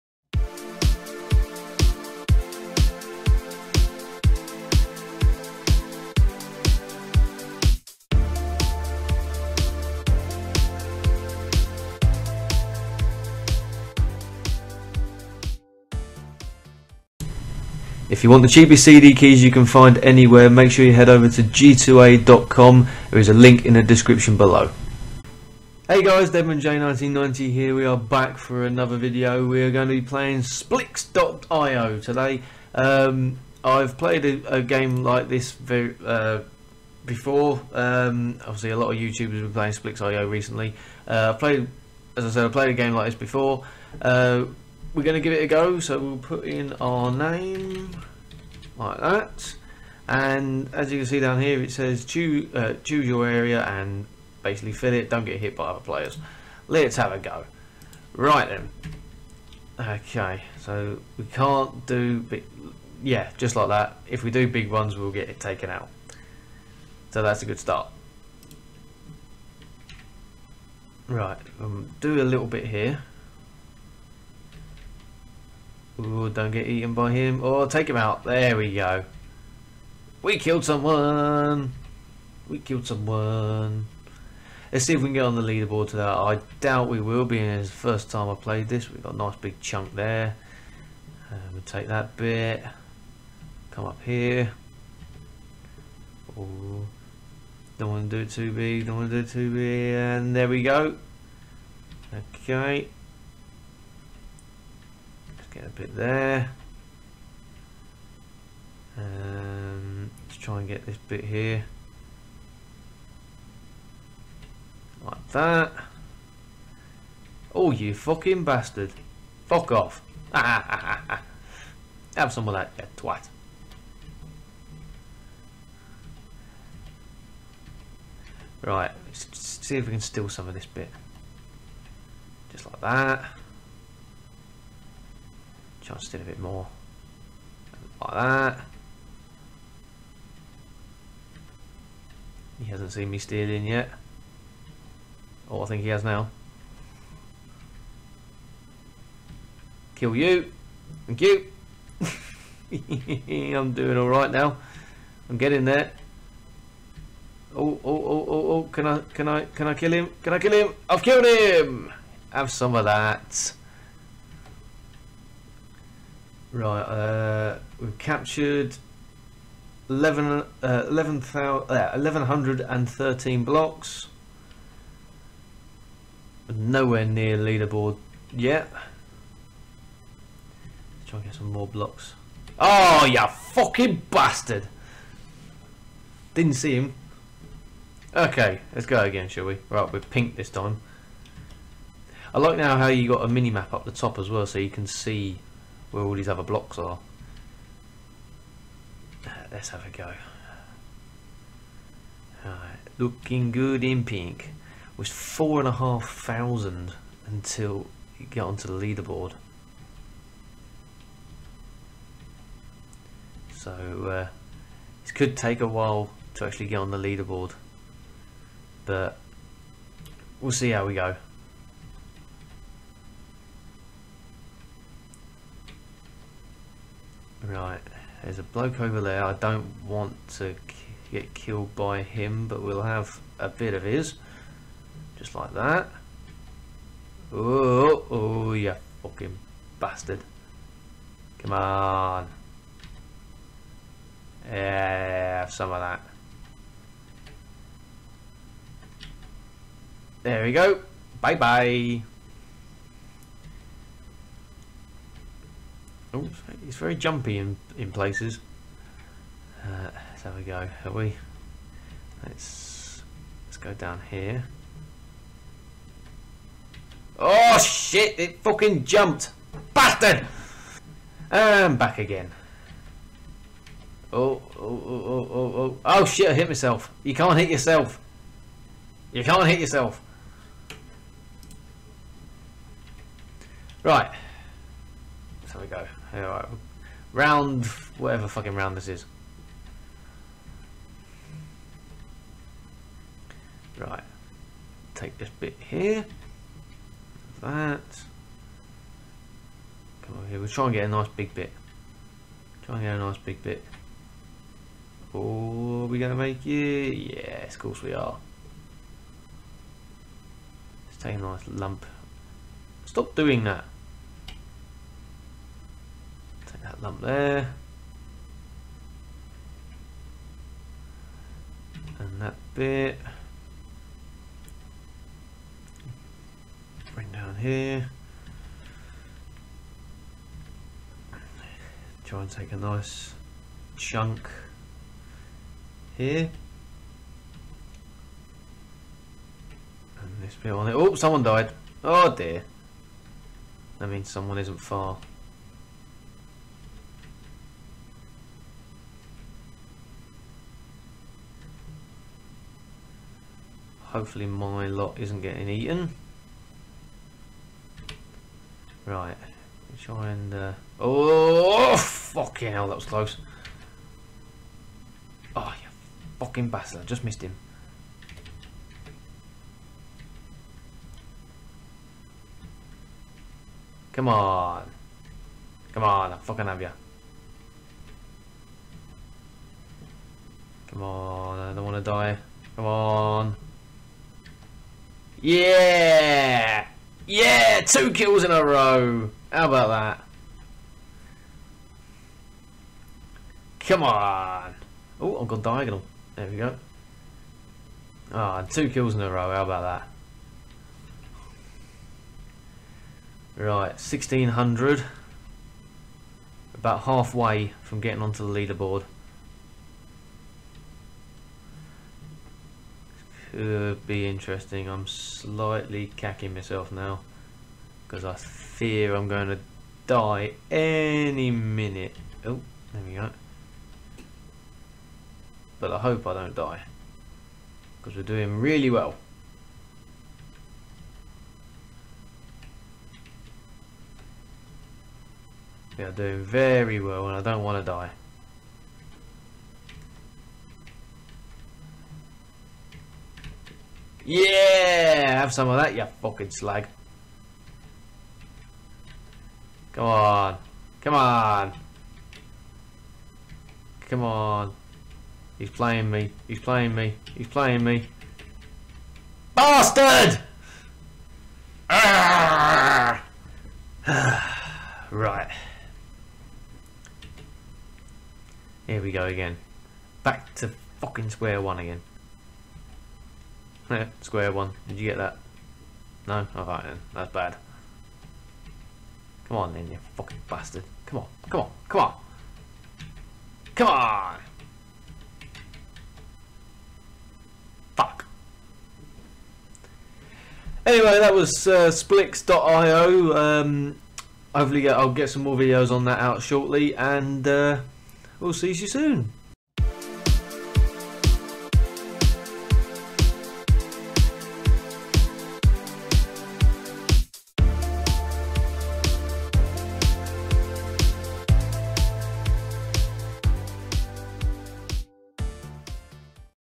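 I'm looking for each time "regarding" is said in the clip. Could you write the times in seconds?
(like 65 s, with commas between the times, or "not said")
not said.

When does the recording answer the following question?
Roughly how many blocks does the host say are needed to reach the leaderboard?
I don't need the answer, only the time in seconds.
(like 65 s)
205 s.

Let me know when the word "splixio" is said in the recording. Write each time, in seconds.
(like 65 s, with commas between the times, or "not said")
30 s, 39 s, 491 s.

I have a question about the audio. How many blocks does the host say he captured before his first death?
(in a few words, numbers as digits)
1113.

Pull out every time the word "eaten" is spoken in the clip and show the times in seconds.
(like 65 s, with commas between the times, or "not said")
76 s, 355 s.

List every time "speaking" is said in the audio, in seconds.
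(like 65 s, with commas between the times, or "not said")
not said.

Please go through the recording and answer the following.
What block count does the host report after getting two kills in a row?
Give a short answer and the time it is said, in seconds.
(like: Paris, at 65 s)
1600, at 403 s.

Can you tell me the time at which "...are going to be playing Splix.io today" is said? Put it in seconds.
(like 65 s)
29 s.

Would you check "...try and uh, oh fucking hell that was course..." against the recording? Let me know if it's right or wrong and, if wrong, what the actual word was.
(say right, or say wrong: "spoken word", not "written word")
wrong: "close", not "course".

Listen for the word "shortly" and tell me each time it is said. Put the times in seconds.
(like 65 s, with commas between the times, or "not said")
496 s.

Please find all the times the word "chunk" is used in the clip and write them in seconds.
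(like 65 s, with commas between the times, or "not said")
89 s, 333 s.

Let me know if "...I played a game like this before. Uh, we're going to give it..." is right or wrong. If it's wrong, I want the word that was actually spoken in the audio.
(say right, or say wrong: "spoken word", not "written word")
right.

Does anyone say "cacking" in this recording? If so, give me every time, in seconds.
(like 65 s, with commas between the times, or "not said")
415 s.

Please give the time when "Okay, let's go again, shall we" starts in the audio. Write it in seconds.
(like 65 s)
188 s.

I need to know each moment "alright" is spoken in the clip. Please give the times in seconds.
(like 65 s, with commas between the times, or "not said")
153 s, 286 s, 476 s.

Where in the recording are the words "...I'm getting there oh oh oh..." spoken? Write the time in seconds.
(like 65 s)
155 s.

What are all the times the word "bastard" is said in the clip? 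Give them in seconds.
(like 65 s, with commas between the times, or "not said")
118 s, 184 s, 239 s, 269 s, 366 s, 459 s, 480 s.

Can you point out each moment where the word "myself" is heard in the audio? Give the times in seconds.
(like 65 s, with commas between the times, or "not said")
276 s, 416 s.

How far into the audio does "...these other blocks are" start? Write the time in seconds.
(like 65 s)
196 s.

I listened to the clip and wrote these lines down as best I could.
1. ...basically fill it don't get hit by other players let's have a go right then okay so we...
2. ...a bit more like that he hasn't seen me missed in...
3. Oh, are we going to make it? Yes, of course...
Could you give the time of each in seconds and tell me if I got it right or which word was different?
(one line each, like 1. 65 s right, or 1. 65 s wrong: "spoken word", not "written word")
1. 54 s right
2. 136 s wrong: "steered", not "missed"
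3. 305 s right.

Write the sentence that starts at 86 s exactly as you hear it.
I doubt we will, being it's the first time I played this.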